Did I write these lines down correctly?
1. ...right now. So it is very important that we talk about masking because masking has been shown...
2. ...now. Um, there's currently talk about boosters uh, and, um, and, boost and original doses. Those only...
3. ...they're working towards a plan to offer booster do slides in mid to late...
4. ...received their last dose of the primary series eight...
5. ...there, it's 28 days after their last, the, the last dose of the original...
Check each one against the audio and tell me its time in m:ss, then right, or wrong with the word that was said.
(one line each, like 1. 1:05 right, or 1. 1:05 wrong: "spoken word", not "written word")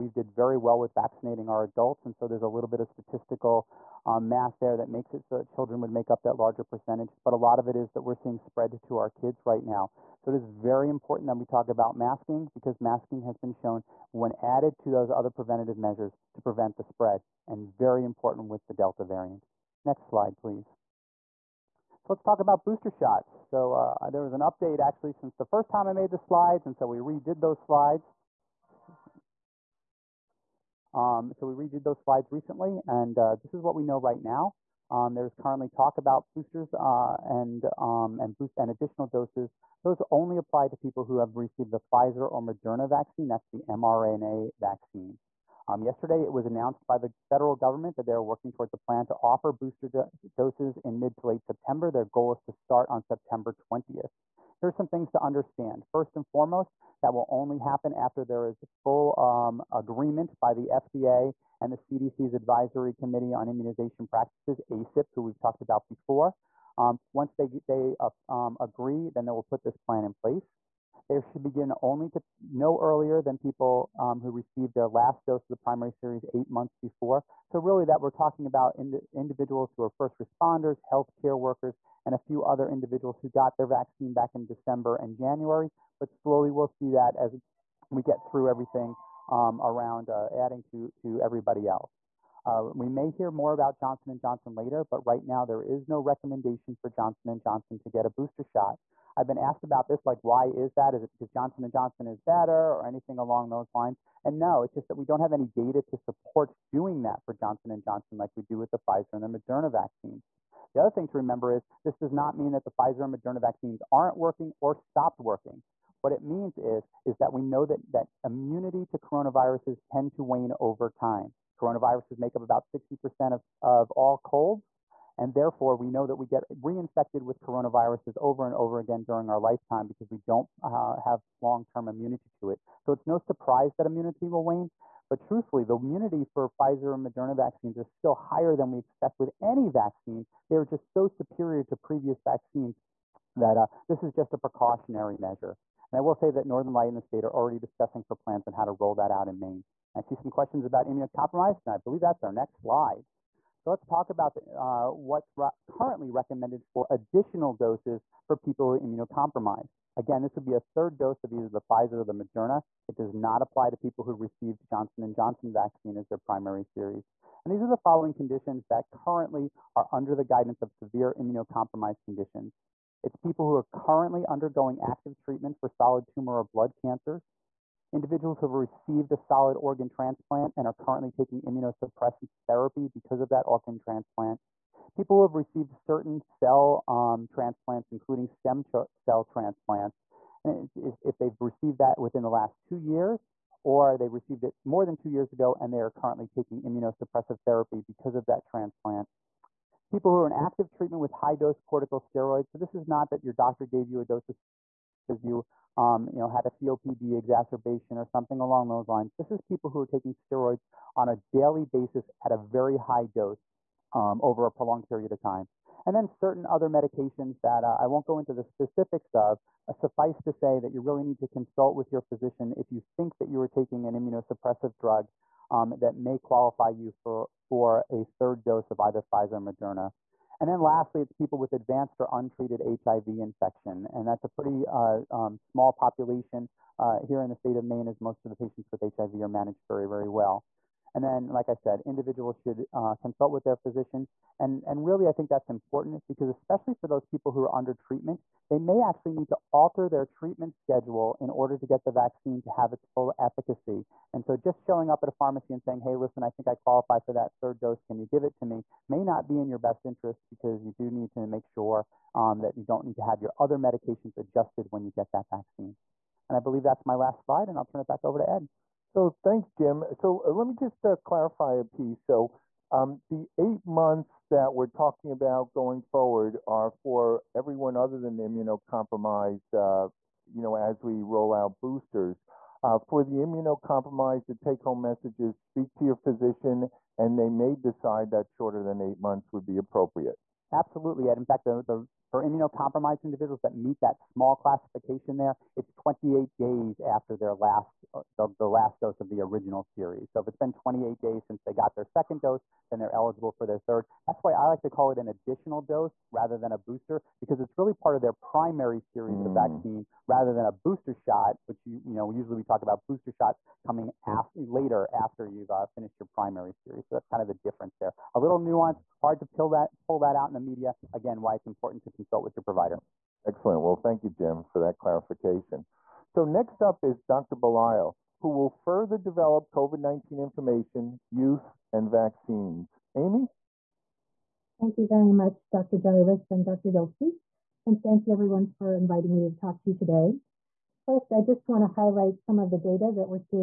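1. 0:09 right
2. 0:34 wrong: "additional", not "original"
3. 0:48 wrong: "doses", not "slides"
4. 1:14 right
5. 4:55 right.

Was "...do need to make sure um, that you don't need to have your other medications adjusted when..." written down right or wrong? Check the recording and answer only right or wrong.
right.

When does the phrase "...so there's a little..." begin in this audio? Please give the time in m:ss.
0:02.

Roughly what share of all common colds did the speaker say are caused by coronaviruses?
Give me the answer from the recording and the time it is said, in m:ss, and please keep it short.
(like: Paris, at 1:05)
60%, at 2:02.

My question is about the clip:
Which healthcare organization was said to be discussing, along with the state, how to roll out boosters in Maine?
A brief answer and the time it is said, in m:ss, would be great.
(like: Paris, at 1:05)
Northern Light, at 2:26.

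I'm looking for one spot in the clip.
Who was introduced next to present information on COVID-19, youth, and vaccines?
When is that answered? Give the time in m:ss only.
5:27.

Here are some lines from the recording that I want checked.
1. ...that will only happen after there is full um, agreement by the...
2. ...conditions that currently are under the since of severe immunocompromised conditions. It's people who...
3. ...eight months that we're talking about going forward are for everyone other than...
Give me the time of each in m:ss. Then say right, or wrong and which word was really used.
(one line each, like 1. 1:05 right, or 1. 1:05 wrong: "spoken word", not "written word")
1. 0:57 right
2. 2:48 wrong: "guidance", not "since"
3. 4:33 right.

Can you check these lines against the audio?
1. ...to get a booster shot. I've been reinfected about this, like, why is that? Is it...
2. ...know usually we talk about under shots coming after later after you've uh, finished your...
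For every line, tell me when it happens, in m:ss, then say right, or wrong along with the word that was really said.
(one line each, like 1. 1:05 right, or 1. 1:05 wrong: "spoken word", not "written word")
1. 1:37 wrong: "asked", not "reinfected"
2. 5:11 wrong: "booster", not "under".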